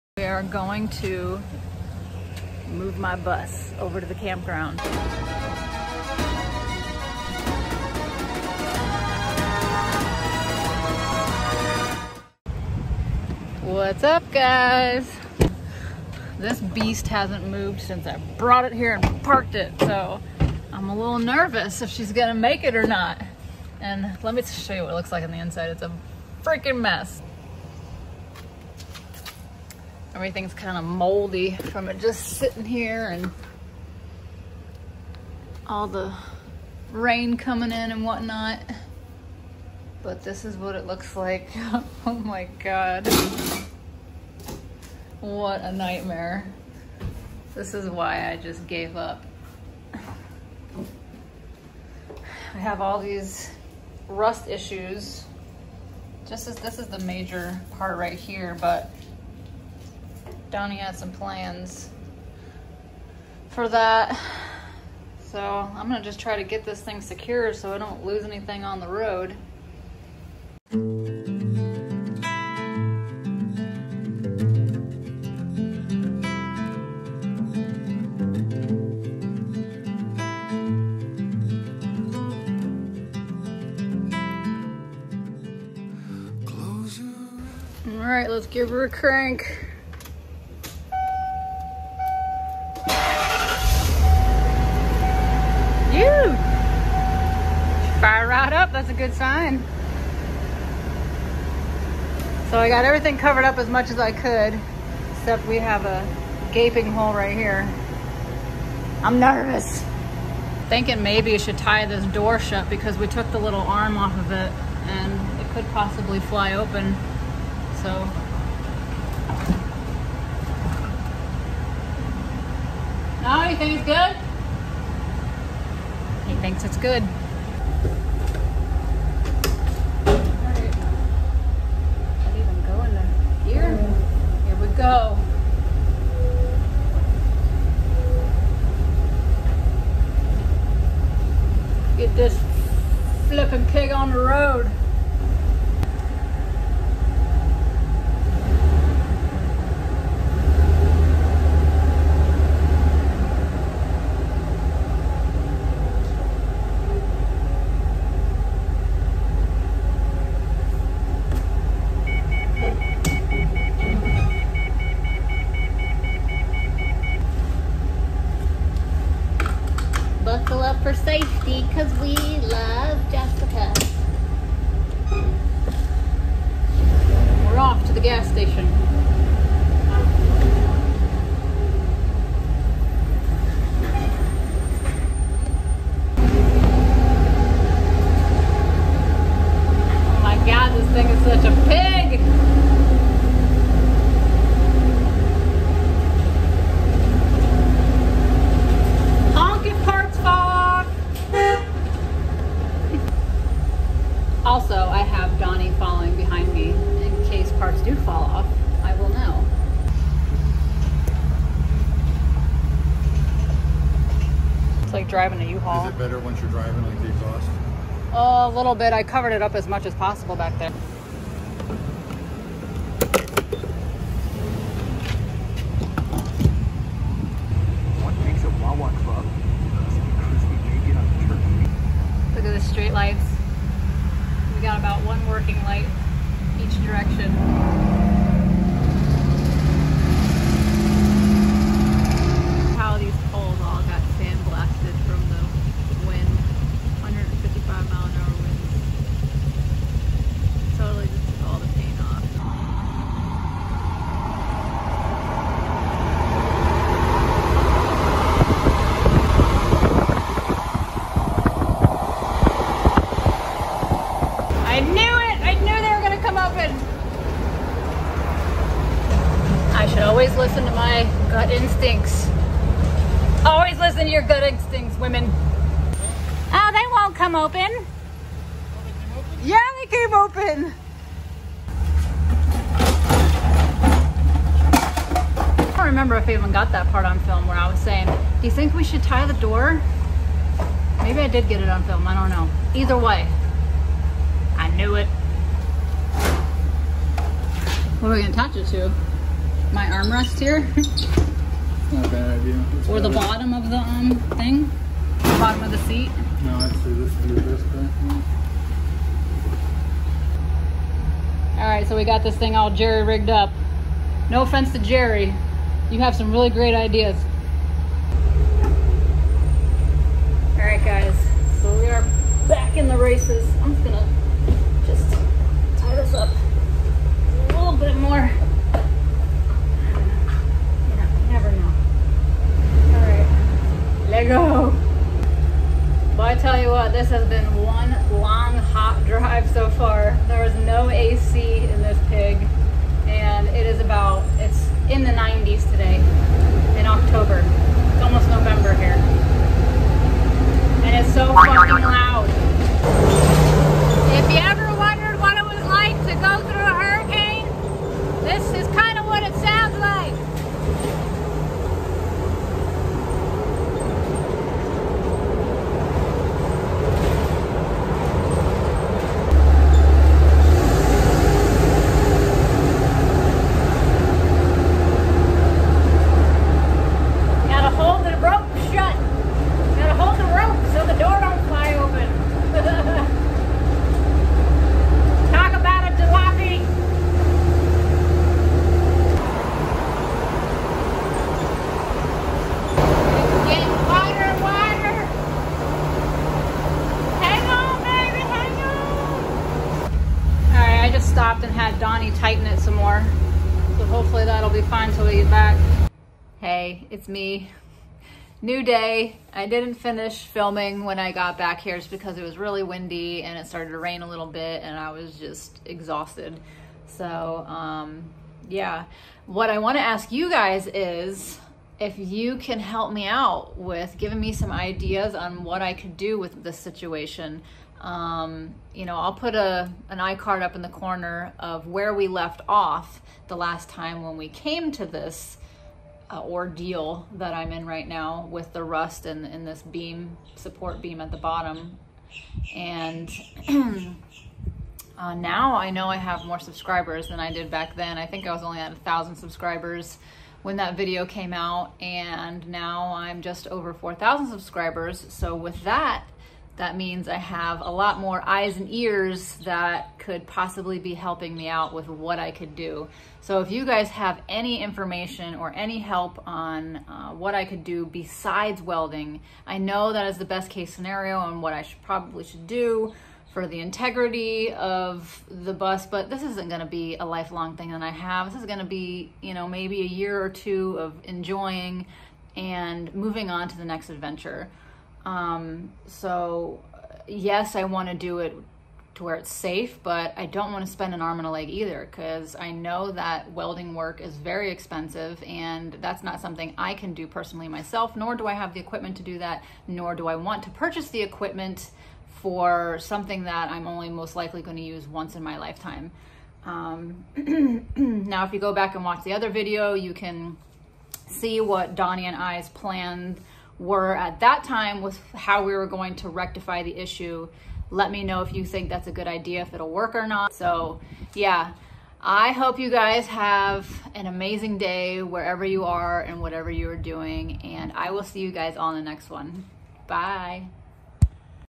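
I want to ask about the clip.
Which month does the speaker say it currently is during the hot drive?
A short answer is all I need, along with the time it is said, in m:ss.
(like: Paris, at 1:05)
October, at 5:46.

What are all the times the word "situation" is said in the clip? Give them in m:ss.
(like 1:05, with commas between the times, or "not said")
7:06.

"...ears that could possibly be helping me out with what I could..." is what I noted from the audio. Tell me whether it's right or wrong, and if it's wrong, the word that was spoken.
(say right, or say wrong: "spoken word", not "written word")
right.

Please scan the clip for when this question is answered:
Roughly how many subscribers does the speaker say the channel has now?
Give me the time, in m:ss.
7:33.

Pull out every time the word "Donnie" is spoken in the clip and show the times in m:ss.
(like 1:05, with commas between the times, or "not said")
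1:00, 6:41, 8:31.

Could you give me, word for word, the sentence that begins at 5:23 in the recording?
I'm just gonna just tie this up a little bit more.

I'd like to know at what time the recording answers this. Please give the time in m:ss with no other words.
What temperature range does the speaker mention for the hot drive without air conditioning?
5:44.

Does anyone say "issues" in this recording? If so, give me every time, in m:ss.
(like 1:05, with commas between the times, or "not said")
0:54, 8:36.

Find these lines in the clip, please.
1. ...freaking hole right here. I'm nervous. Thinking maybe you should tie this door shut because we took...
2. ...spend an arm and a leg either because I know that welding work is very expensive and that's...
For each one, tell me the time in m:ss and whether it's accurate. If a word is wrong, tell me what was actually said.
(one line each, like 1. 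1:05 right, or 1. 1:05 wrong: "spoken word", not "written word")
1. 1:46 wrong: "gaping", not "freaking"
2. 8:10 right.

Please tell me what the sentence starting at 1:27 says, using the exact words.
All right, let's give her a crank.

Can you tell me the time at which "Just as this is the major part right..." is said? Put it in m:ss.
0:56.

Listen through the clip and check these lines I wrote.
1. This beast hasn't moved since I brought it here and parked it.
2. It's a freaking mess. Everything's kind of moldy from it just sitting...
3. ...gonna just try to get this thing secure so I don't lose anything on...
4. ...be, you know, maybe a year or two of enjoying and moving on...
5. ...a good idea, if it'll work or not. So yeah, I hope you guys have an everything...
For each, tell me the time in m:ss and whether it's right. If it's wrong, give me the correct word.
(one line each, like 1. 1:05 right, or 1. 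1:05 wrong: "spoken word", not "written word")
1. 0:16 right
2. 0:25 right
3. 1:05 right
4. 7:58 right
5. 8:38 wrong: "amazing", not "everything".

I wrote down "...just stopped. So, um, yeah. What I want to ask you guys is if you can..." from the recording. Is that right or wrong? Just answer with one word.
wrong.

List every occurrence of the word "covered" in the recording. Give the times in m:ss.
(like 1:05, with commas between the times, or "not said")
1:43, 3:39.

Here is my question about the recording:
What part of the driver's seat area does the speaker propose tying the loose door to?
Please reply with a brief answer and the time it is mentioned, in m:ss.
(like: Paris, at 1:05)
armrest, at 4:59.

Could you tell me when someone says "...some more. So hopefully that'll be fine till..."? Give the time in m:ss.
6:42.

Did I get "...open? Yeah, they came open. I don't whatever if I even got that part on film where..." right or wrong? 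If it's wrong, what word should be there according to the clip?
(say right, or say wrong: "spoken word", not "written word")
wrong: "remember", not "whatever".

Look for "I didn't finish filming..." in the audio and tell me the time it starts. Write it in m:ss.
6:49.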